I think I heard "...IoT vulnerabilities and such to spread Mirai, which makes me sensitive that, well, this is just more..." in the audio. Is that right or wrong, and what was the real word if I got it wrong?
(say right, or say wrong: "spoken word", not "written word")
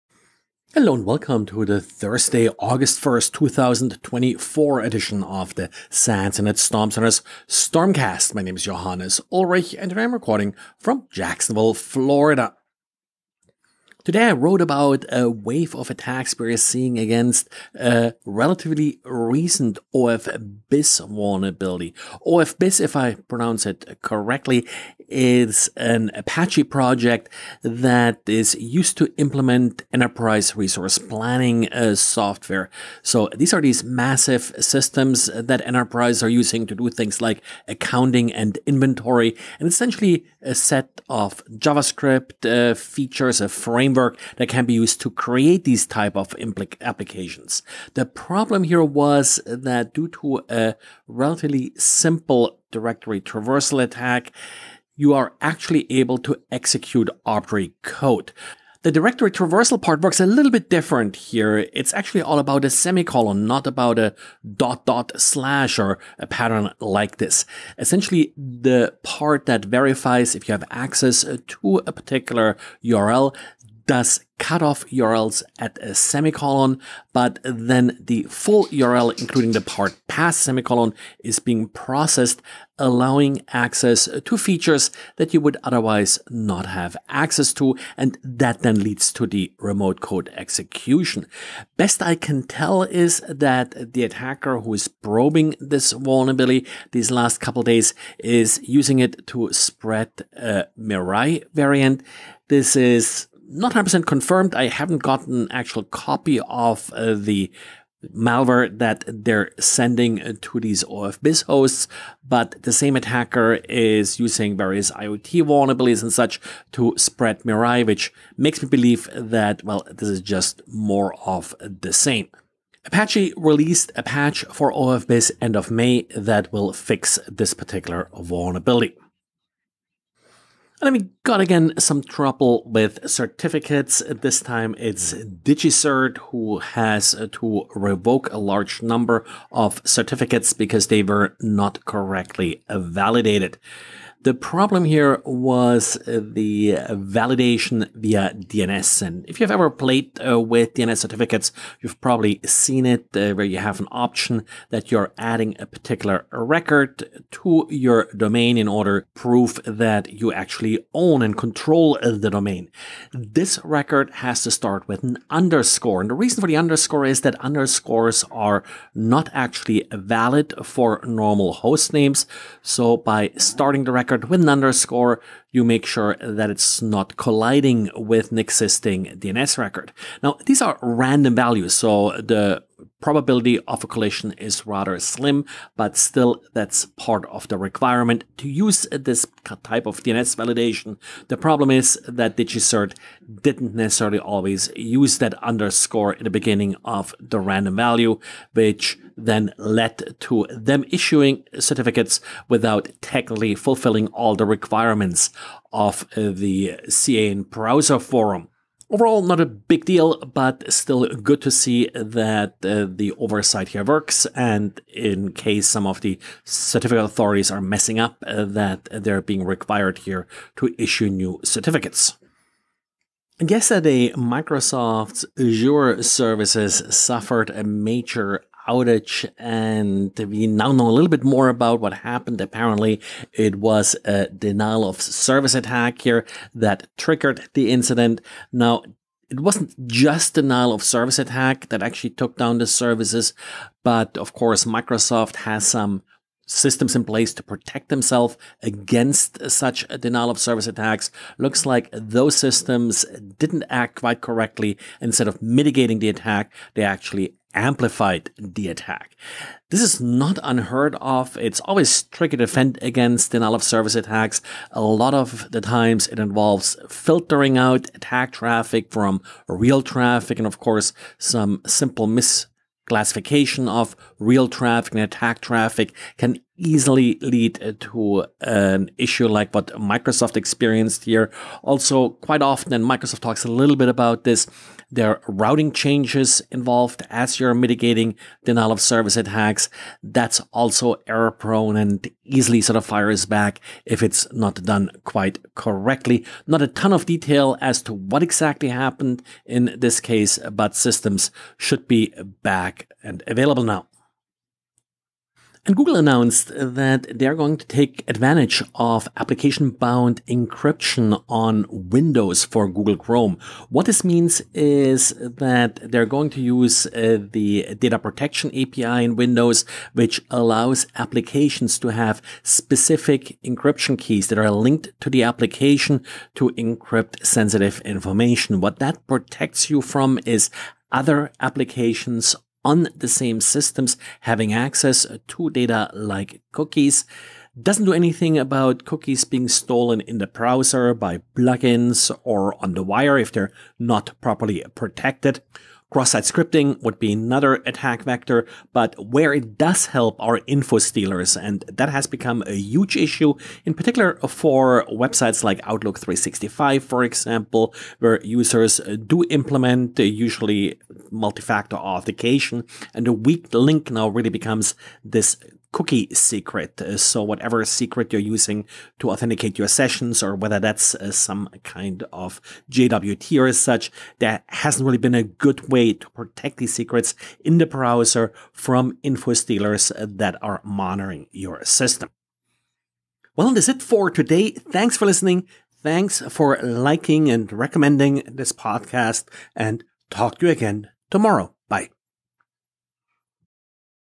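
wrong: "believe", not "sensitive".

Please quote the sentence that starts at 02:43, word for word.
This record has to start with an underscore.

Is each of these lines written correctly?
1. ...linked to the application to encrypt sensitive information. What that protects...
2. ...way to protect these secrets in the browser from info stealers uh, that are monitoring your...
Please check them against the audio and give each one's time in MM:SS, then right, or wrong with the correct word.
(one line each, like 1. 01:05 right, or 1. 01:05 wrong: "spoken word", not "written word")
1. 05:24 right
2. 06:15 right.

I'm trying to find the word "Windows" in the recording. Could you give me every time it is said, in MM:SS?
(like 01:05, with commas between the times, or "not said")
05:11, 05:19.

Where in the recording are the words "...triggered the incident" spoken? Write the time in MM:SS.
03:56.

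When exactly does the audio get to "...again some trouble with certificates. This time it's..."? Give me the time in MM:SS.
02:11.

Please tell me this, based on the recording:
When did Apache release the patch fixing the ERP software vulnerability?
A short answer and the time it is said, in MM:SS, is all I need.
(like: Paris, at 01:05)
end of May, at 02:05.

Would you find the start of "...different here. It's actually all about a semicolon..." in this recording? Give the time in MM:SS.
01:00.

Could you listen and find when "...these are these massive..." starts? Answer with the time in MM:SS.
00:33.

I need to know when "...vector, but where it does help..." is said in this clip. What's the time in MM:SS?
05:48.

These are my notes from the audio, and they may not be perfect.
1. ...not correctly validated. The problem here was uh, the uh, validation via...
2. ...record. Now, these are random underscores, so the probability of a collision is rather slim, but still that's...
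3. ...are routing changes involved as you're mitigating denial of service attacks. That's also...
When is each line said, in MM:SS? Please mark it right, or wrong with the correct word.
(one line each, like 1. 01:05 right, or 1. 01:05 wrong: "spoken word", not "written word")
1. 02:21 right
2. 02:59 wrong: "values", not "underscores"
3. 04:45 right.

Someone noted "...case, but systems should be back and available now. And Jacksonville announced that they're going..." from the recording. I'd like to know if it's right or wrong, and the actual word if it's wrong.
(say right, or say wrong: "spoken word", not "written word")
wrong: "Google", not "Jacksonville".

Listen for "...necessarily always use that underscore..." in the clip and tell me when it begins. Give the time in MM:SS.
03:13.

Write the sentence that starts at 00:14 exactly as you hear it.
Today I wrote about a wave of attacks we're seeing against a relatively recent OFBiz vulnerability.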